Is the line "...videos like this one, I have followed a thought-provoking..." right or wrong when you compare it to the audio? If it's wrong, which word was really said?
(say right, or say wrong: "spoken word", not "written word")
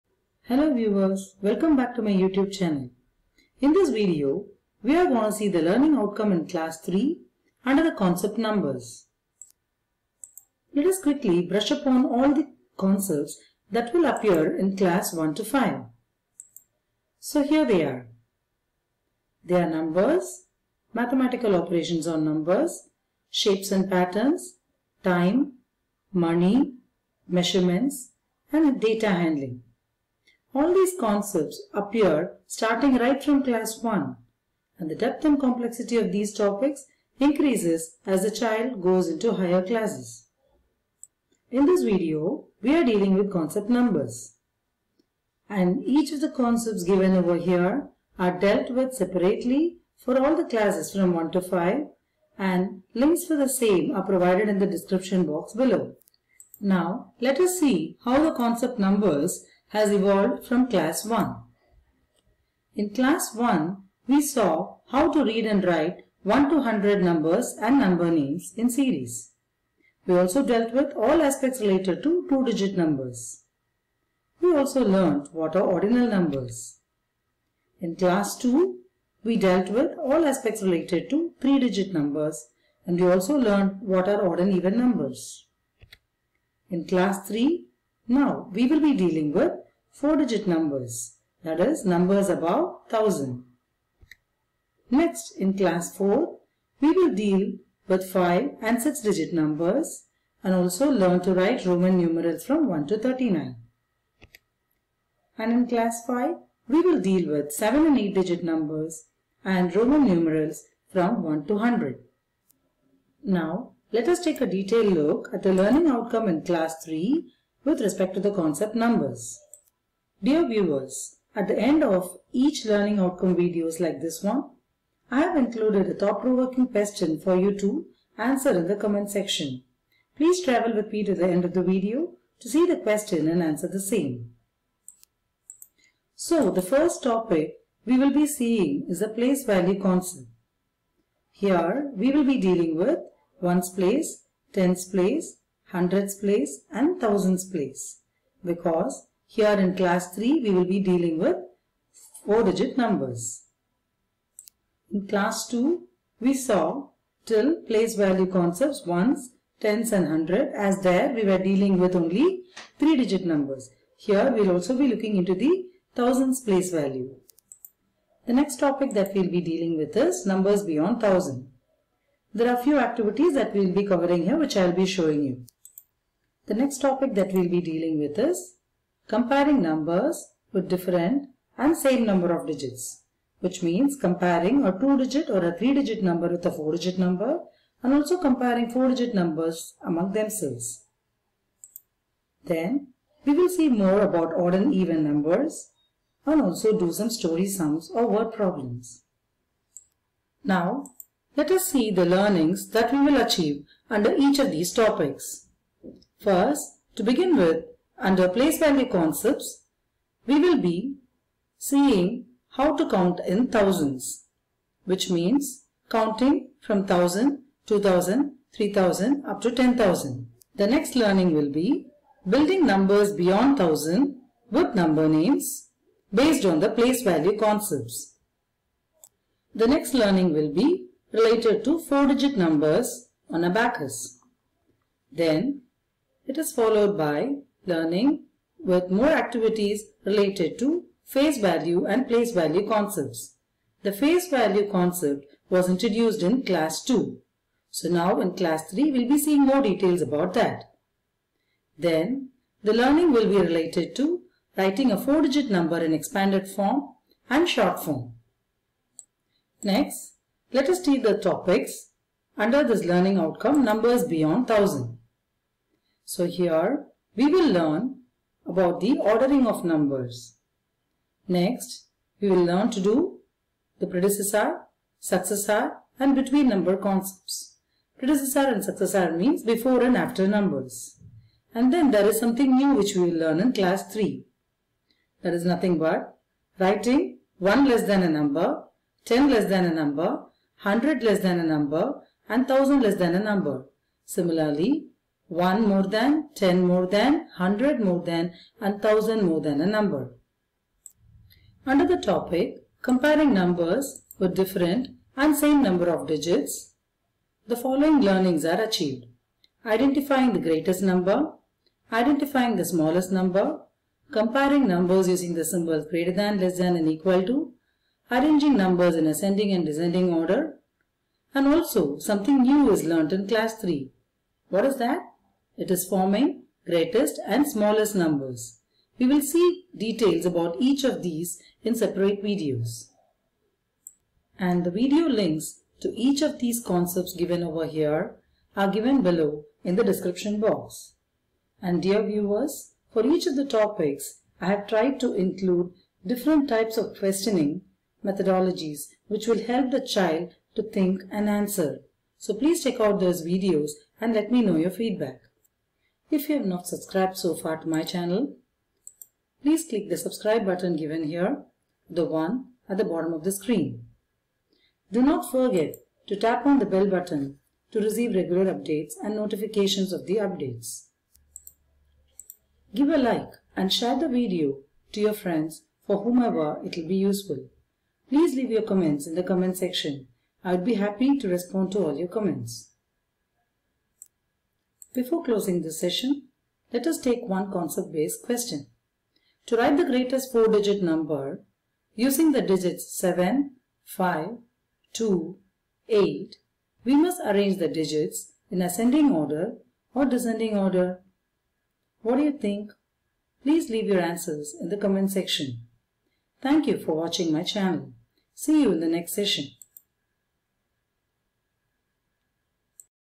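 wrong: "included", not "followed".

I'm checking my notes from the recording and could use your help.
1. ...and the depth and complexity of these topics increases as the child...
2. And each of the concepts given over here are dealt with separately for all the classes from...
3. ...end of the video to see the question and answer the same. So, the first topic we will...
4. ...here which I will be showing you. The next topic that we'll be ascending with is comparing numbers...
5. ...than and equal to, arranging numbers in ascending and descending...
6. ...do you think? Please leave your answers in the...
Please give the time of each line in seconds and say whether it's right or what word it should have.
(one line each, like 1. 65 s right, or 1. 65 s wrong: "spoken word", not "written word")
1. 34 s right
2. 45 s right
3. 131 s right
4. 174 s wrong: "dealing", not "ascending"
5. 316 s right
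6. 402 s right.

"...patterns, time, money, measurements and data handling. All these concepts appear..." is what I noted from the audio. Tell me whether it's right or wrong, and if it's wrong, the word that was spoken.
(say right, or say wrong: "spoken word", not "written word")
right.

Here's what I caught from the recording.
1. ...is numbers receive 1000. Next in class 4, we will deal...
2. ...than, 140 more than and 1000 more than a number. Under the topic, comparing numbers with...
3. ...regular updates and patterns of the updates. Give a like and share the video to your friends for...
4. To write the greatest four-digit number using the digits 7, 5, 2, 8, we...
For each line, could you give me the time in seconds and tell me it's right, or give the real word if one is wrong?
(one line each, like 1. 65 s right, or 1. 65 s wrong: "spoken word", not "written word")
1. 91 s wrong: "above", not "receive"
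2. 296 s wrong: "100", not "140"
3. 368 s wrong: "notifications", not "patterns"
4. 389 s right.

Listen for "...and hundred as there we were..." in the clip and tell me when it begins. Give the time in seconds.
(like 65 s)
159 s.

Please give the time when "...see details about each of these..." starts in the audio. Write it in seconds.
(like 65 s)
329 s.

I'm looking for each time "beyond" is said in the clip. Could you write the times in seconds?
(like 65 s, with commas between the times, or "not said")
170 s, 223 s, 264 s.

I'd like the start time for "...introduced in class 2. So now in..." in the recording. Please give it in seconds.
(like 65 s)
245 s.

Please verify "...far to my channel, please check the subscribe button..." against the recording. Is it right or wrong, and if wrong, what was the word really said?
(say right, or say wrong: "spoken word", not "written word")
wrong: "click", not "check".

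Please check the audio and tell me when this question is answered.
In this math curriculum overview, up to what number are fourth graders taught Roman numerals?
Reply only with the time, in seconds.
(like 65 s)
102 s.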